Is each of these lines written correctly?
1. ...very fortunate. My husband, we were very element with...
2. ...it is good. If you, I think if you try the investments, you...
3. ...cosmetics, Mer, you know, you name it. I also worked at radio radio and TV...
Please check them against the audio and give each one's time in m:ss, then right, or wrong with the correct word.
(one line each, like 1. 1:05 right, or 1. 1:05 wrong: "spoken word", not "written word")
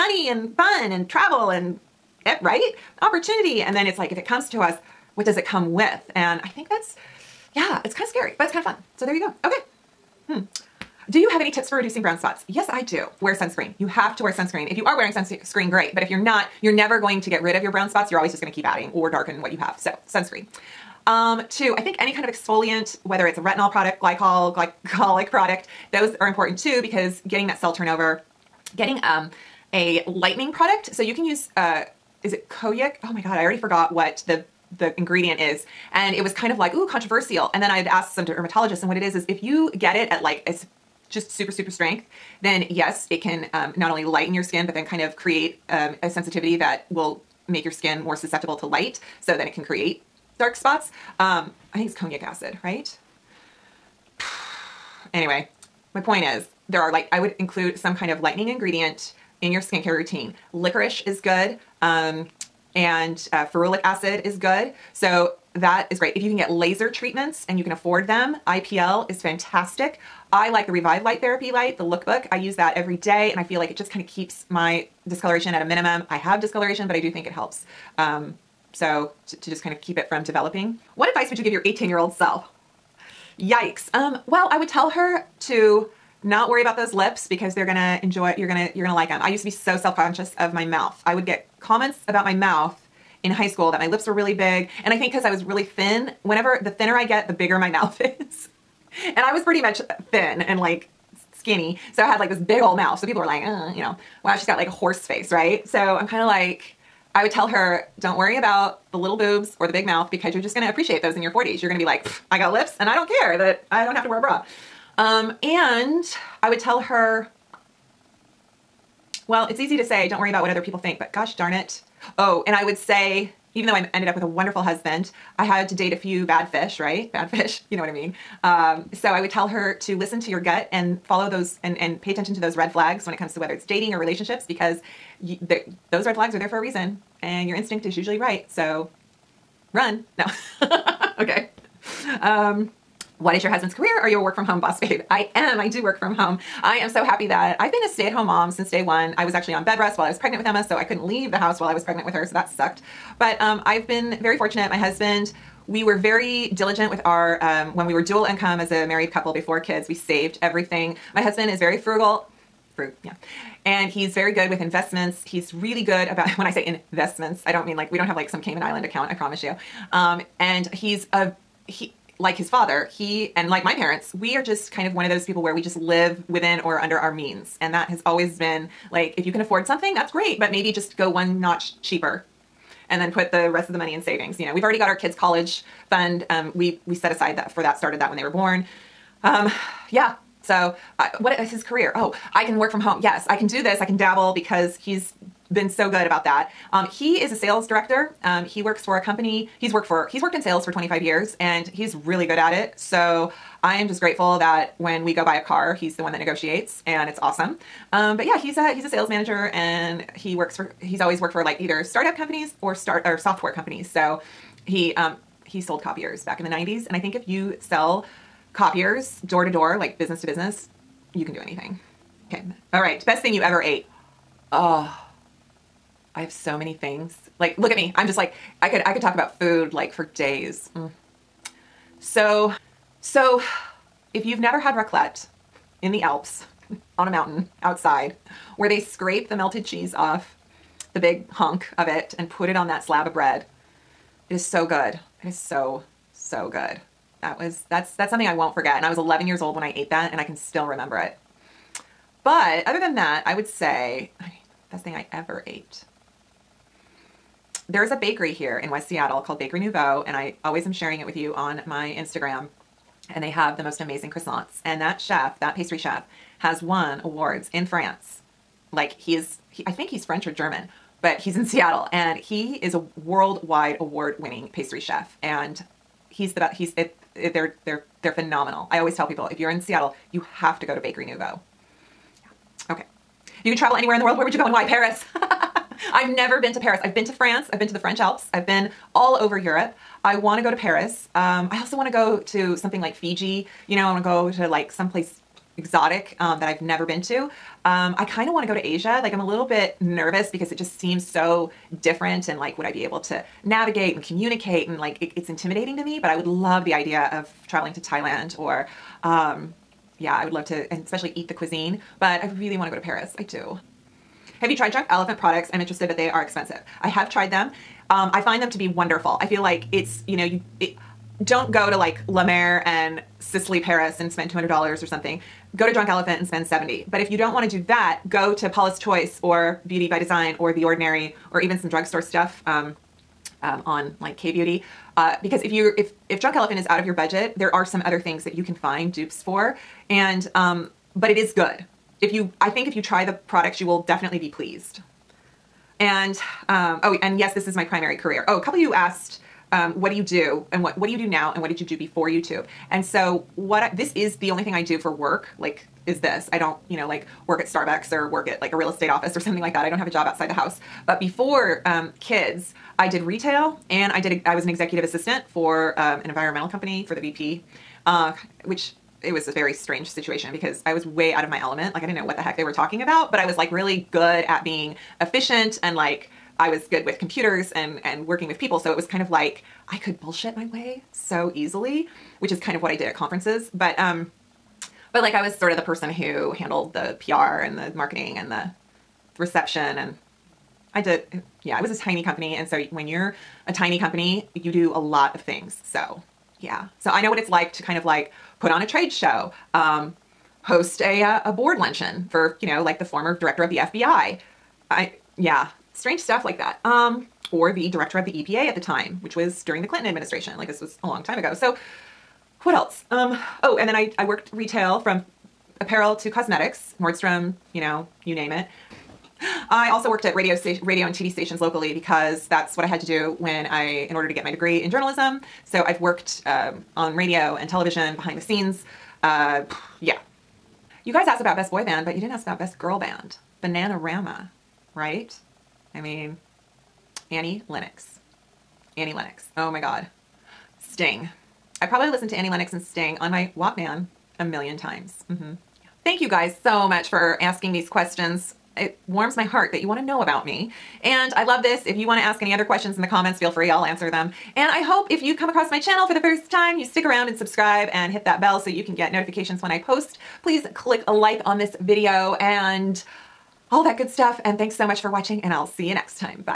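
1. 2:34 wrong: "diligent", not "element"
2. 5:41 wrong: "products", not "investments"
3. 6:56 wrong: "Nordstrom", not "Mer".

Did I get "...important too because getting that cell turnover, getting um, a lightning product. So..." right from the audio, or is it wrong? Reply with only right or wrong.
right.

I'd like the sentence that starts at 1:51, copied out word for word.
You're gonna be like, I got lips and I don't care that I don't have to wear a bra.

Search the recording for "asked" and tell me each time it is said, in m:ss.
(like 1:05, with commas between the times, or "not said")
0:37, 5:48, 7:11.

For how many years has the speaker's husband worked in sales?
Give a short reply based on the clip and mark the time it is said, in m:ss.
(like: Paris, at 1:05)
25, at 3:20.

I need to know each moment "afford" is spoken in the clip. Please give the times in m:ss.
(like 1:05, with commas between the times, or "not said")
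1:07, 2:59.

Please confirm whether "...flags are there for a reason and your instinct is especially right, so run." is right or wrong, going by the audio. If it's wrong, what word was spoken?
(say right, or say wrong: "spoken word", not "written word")
wrong: "usually", not "especially".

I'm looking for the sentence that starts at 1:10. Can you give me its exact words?
I like the Revive Light Therapy light, the lookbook.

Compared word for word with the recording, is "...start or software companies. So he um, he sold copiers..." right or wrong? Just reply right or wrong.
right.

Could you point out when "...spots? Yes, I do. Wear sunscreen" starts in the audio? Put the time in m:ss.
0:12.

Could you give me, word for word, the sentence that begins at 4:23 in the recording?
And they have the most amazing croissants.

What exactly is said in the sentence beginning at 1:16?
I have discoloration, but I do think it helps.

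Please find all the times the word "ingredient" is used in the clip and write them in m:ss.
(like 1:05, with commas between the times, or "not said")
0:34, 0:58.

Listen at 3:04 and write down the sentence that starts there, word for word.
You know, we've already got our kids' college fund.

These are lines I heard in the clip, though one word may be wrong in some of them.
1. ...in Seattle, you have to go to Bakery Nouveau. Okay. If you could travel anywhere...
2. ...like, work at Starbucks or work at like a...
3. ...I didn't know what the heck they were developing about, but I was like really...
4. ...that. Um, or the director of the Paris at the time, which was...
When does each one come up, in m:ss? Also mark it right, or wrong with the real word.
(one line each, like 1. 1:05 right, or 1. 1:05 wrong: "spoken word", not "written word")
1. 4:39 right
2. 5:56 right
3. 6:11 wrong: "talking", not "developing"
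4. 6:46 wrong: "EPA", not "Paris".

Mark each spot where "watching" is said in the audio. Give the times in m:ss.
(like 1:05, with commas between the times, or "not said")
7:44.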